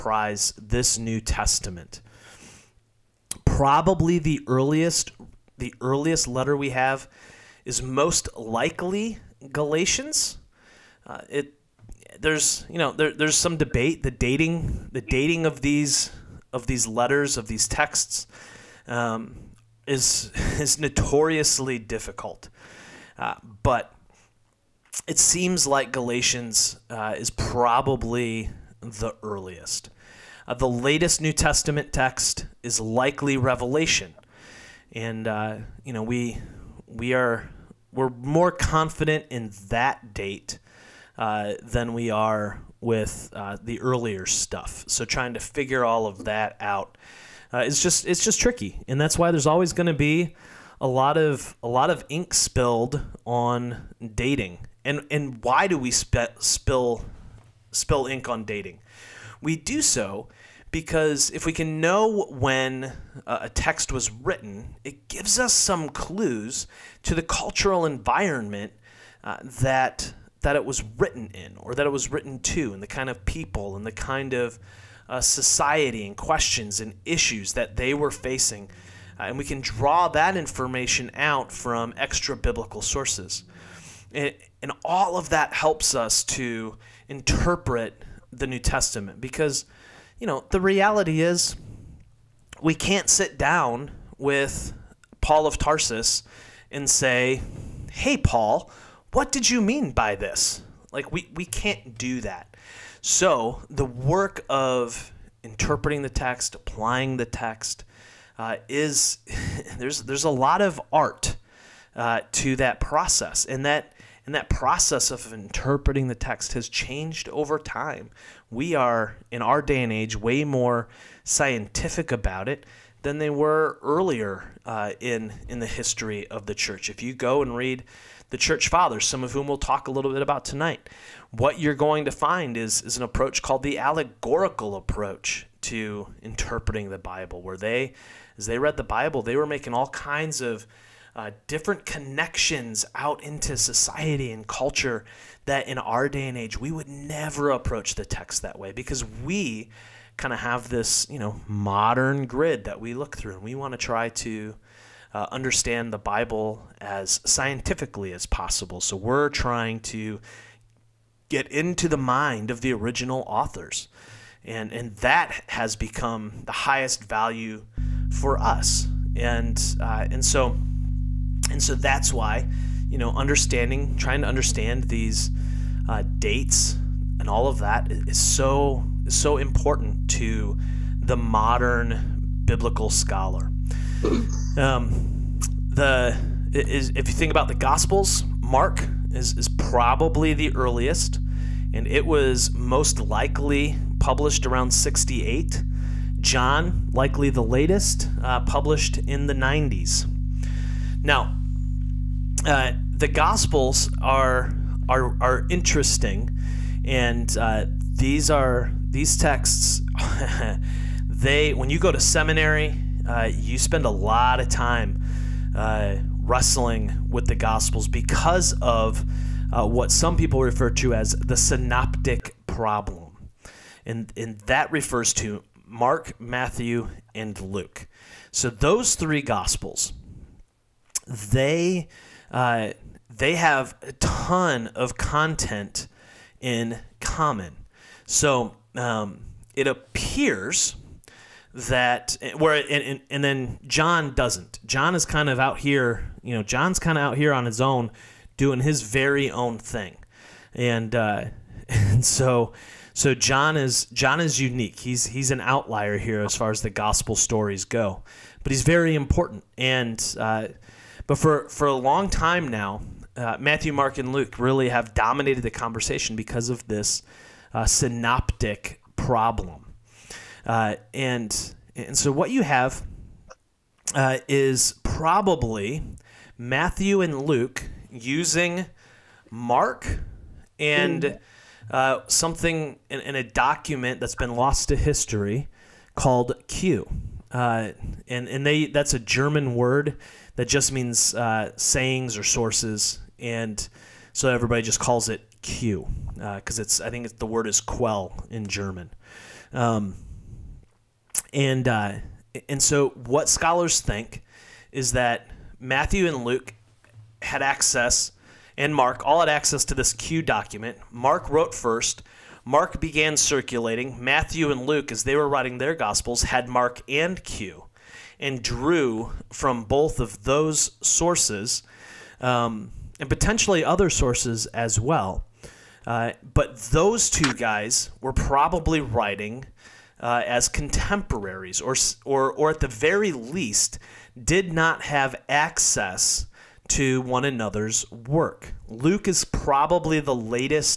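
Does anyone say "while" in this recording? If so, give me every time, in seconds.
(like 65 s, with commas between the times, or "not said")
not said.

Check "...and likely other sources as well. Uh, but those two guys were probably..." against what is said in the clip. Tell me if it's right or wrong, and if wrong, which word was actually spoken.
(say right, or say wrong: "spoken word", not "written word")
wrong: "potentially", not "likely".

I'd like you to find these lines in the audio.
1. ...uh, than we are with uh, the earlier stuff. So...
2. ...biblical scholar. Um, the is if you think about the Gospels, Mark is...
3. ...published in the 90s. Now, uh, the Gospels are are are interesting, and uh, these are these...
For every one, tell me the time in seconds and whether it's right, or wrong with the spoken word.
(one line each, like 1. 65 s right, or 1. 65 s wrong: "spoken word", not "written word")
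1. 41 s right
2. 182 s right
3. 198 s right.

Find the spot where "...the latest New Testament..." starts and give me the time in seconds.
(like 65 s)
30 s.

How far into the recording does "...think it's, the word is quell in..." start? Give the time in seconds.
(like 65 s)
296 s.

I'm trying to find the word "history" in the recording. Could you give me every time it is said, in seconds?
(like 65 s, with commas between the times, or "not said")
125 s, 284 s.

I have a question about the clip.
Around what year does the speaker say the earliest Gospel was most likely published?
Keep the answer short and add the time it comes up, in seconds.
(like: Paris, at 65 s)
68, at 194 s.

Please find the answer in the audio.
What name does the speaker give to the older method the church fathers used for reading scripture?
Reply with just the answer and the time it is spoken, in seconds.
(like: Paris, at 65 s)
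allegorical approach, at 133 s.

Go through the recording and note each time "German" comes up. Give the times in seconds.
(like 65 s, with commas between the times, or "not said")
289 s, 298 s.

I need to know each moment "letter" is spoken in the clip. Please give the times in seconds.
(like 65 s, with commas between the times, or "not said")
6 s, 16 s.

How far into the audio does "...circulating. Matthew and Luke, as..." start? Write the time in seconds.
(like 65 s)
313 s.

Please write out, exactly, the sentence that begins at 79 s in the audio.
Uh, and we can draw that information out from extra biblical sources.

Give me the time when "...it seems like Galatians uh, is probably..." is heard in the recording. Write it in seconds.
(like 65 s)
25 s.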